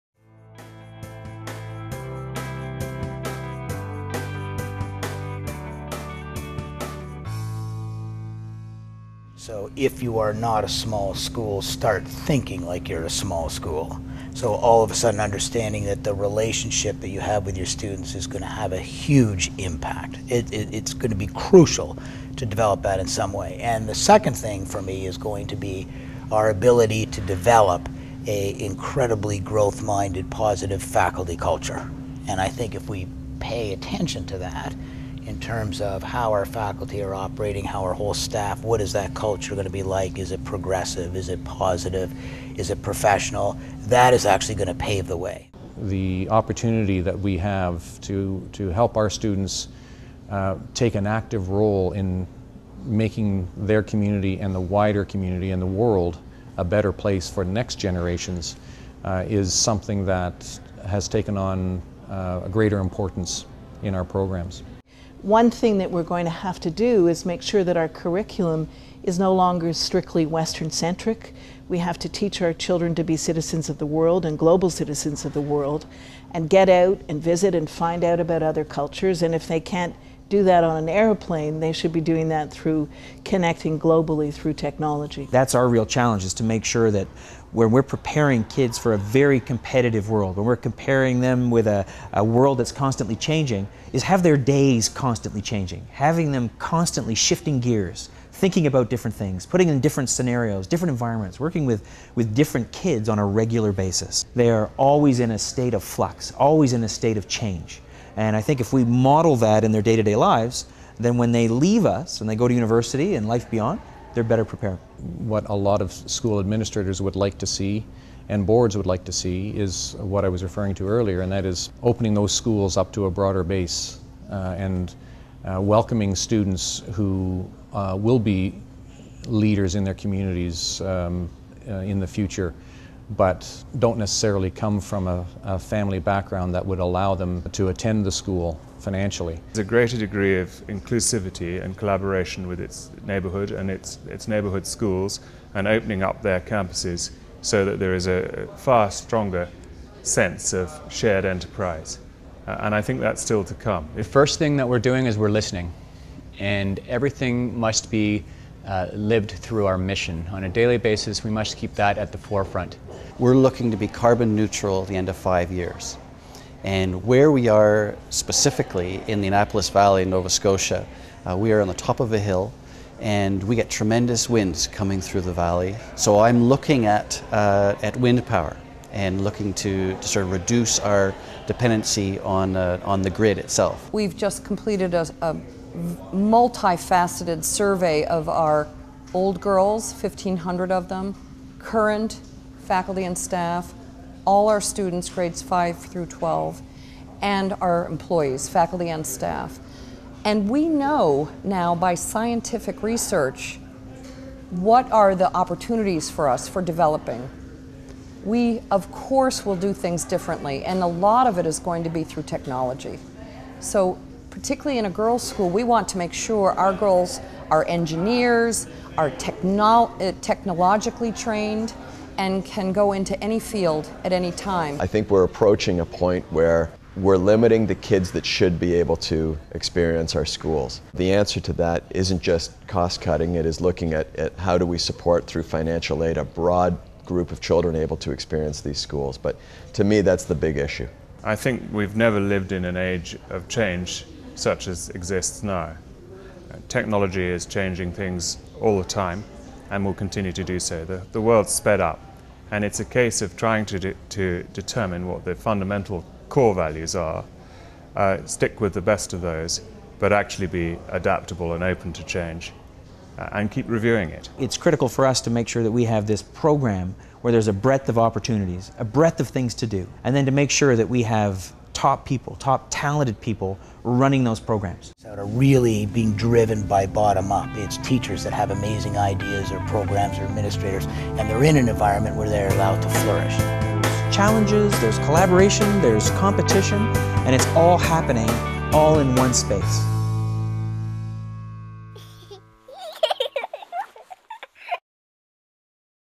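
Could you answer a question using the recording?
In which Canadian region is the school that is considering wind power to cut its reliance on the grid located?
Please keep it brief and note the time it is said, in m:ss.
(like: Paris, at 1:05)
Annapolis Valley, at 2:49.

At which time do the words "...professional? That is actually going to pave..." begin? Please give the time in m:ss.
0:42.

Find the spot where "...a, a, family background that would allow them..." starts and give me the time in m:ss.
2:15.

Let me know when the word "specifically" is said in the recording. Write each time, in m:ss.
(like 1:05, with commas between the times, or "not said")
2:48.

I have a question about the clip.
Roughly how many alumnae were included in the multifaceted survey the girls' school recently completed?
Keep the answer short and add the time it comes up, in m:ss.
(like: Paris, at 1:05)
1,500, at 3:09.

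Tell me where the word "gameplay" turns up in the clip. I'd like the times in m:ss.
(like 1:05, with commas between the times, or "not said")
not said.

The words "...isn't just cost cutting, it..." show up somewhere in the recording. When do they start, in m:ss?
3:51.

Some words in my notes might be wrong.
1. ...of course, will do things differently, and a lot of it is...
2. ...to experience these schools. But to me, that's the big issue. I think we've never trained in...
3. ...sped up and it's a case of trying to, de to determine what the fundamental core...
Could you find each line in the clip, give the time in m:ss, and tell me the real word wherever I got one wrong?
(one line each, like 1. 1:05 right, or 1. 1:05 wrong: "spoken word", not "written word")
1. 3:28 right
2. 3:57 wrong: "lived", not "trained"
3. 4:11 right.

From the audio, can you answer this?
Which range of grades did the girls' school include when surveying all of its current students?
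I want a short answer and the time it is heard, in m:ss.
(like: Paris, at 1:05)
5 through 12, at 3:15.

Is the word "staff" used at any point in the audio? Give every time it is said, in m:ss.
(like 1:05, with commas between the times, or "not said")
0:38, 3:13, 3:19.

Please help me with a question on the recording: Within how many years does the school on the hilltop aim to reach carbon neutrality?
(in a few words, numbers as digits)
5.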